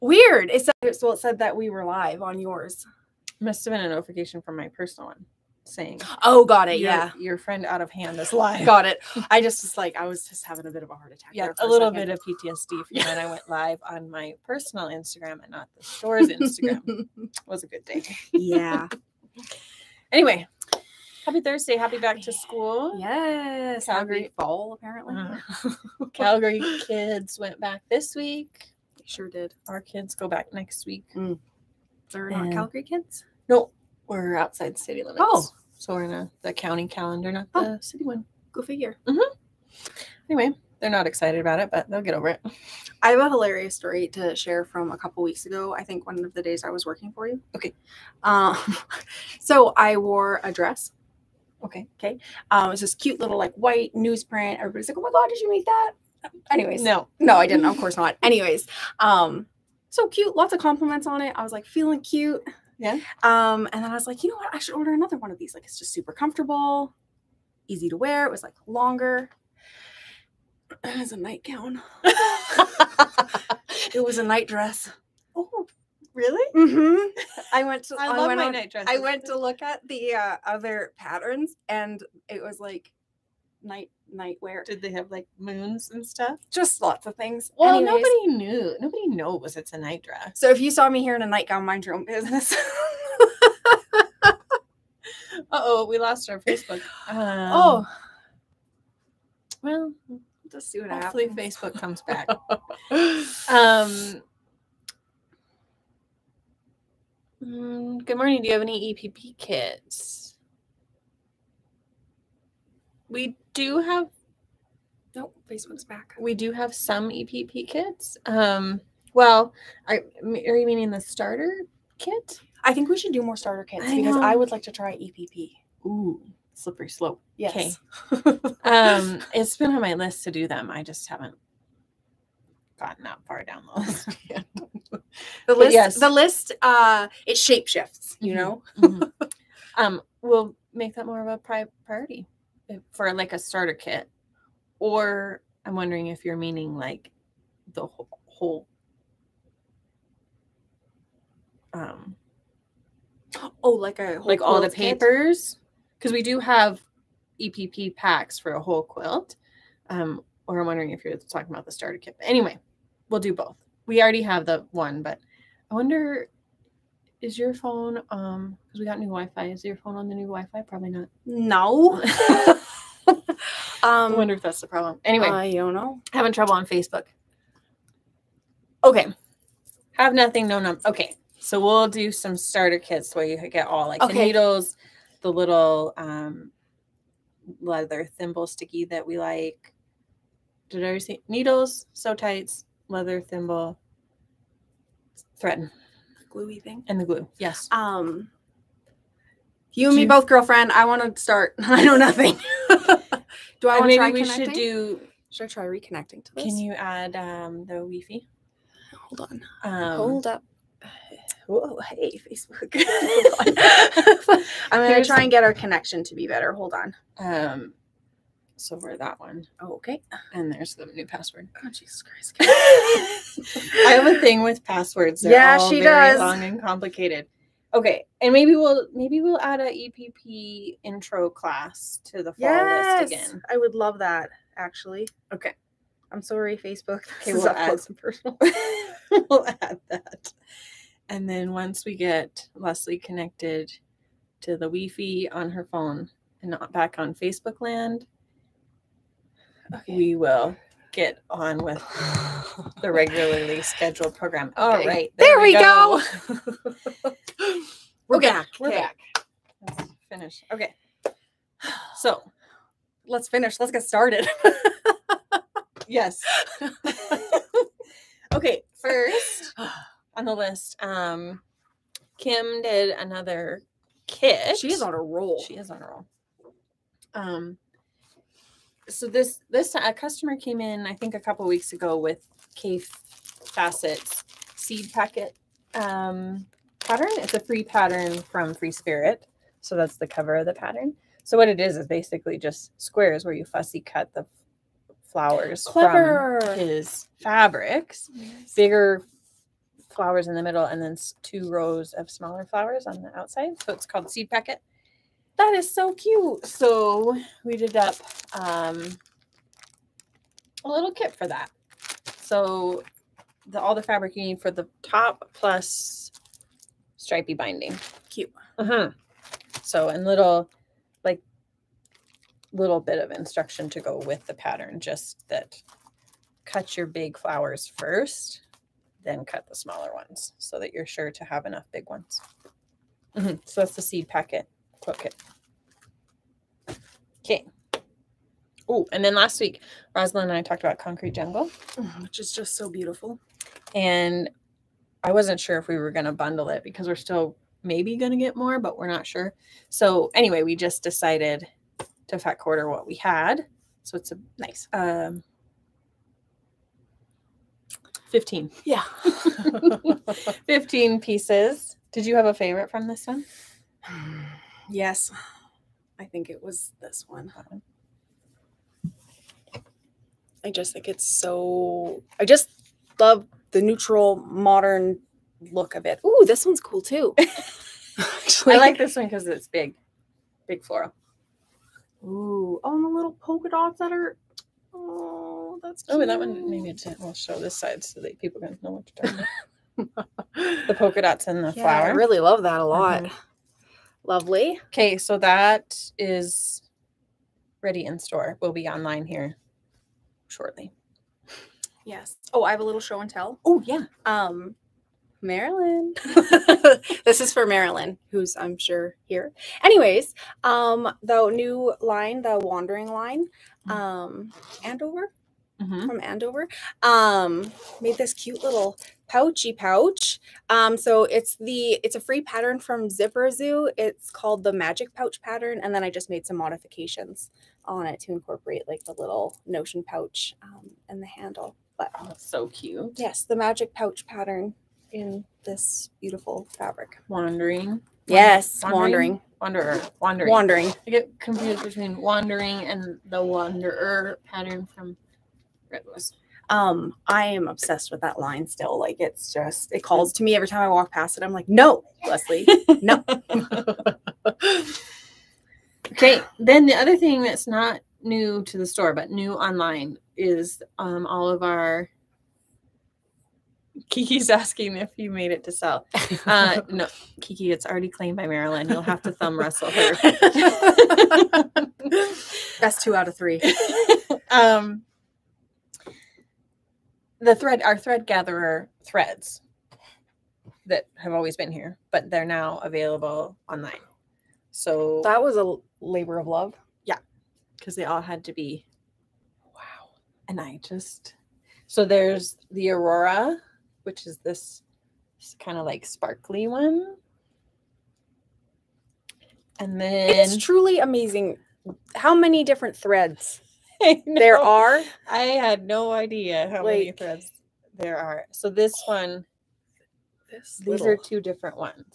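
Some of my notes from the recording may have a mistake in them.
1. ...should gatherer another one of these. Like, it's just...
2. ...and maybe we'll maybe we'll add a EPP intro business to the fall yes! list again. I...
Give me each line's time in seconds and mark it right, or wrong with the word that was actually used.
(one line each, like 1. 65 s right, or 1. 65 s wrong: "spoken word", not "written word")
1. 64 s wrong: "order", not "gatherer"
2. 228 s wrong: "class", not "business".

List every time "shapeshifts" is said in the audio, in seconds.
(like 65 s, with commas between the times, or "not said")
137 s.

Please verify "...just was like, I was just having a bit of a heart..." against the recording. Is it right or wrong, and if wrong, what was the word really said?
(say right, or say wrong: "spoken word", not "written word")
right.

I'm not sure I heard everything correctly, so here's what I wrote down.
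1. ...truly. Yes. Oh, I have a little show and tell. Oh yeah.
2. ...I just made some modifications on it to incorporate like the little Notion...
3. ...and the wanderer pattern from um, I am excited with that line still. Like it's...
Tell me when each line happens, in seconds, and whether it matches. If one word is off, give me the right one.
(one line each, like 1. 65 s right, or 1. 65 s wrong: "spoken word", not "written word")
1. 400 s wrong: "shortly", not "truly"
2. 425 s right
3. 442 s wrong: "obsessed", not "excited".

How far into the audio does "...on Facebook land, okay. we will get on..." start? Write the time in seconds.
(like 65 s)
246 s.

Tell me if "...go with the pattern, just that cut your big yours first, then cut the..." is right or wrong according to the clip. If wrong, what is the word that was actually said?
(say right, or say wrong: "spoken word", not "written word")
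wrong: "flowers", not "yours".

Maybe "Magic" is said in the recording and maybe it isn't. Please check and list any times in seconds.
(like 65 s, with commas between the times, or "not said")
424 s, 433 s.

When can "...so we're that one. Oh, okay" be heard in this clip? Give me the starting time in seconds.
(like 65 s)
218 s.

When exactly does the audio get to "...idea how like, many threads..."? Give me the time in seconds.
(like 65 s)
505 s.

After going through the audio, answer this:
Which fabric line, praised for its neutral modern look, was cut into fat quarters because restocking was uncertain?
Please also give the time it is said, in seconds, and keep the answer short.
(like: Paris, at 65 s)
Concrete Jungle, at 340 s.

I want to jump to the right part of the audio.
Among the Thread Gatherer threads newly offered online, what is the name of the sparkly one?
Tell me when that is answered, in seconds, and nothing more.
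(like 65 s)
492 s.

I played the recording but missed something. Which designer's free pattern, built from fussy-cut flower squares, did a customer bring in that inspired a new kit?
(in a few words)
Kaffe Fassett.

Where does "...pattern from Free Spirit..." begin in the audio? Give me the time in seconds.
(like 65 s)
287 s.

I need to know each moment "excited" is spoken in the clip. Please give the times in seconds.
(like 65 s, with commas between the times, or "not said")
41 s.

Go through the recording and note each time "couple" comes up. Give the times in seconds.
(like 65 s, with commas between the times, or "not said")
44 s, 281 s.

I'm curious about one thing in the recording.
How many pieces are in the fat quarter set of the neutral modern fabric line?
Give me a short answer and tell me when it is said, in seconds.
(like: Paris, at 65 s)
15, at 360 s.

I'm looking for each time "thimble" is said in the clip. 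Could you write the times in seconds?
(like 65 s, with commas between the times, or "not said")
188 s, 193 s.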